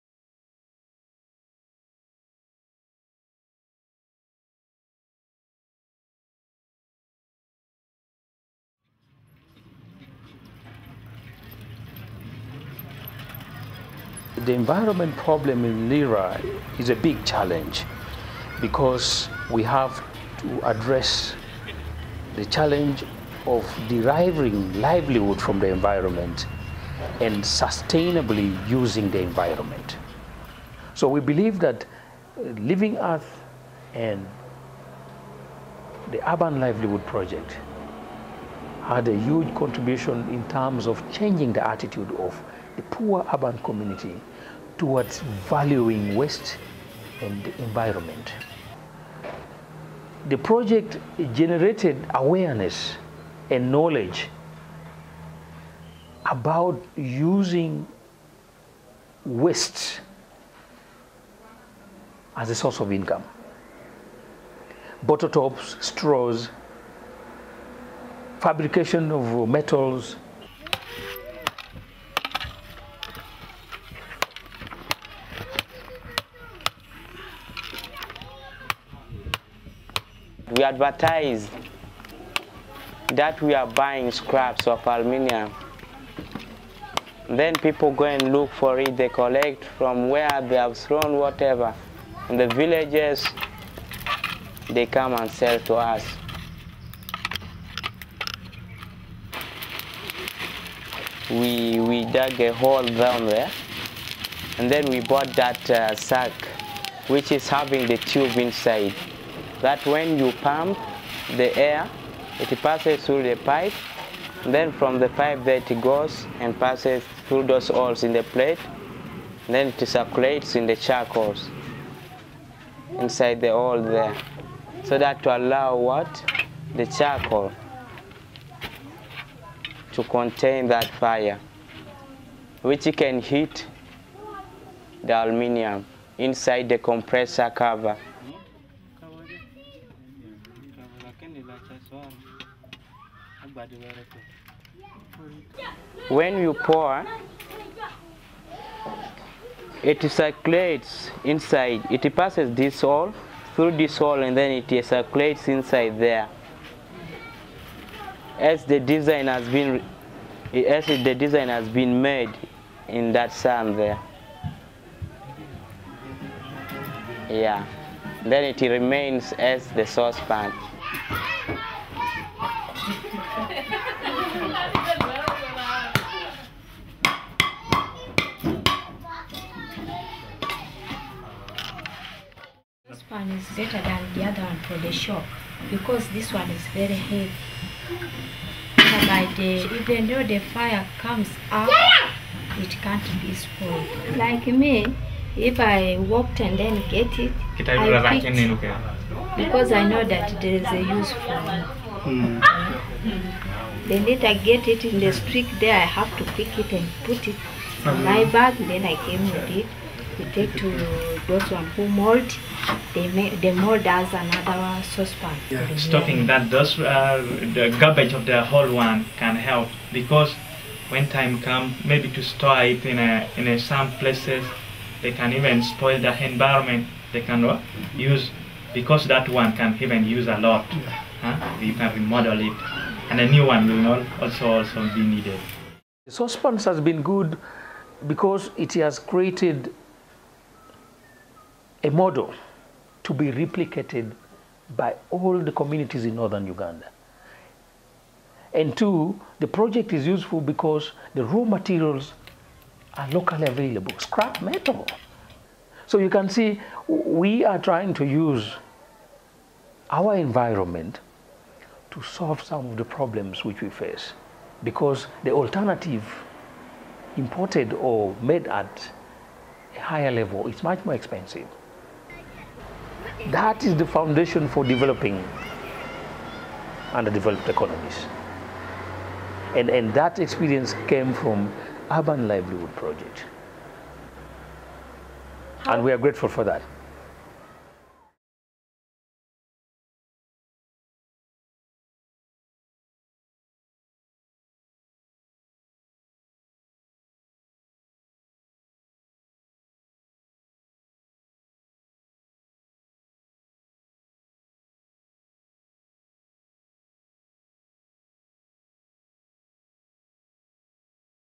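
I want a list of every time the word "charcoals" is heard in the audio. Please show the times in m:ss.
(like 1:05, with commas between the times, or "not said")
2:00, 2:06.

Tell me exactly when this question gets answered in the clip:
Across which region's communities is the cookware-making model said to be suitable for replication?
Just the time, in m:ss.
4:06.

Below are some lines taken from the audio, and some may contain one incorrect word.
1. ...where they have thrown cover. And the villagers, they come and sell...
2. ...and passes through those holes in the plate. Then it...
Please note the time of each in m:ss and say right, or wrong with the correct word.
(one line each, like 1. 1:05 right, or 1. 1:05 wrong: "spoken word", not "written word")
1. 1:30 wrong: "whatever", not "cover"
2. 1:56 right.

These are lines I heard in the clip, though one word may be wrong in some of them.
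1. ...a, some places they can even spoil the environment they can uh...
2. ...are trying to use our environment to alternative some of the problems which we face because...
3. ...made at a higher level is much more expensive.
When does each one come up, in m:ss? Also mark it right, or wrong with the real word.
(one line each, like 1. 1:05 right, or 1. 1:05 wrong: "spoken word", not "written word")
1. 3:43 right
2. 4:17 wrong: "solve", not "alternative"
3. 4:28 right.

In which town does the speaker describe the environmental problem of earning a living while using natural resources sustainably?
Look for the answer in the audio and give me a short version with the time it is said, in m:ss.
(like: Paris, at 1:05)
Lira, at 0:15.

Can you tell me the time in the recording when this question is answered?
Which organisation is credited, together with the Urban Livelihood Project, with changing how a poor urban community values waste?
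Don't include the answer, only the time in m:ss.
0:32.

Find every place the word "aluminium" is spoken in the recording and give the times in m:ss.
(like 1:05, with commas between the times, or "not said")
1:24, 2:15.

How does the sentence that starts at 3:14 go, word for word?
Like me, if I walked and then get it, I picked because I know that there is a use for it.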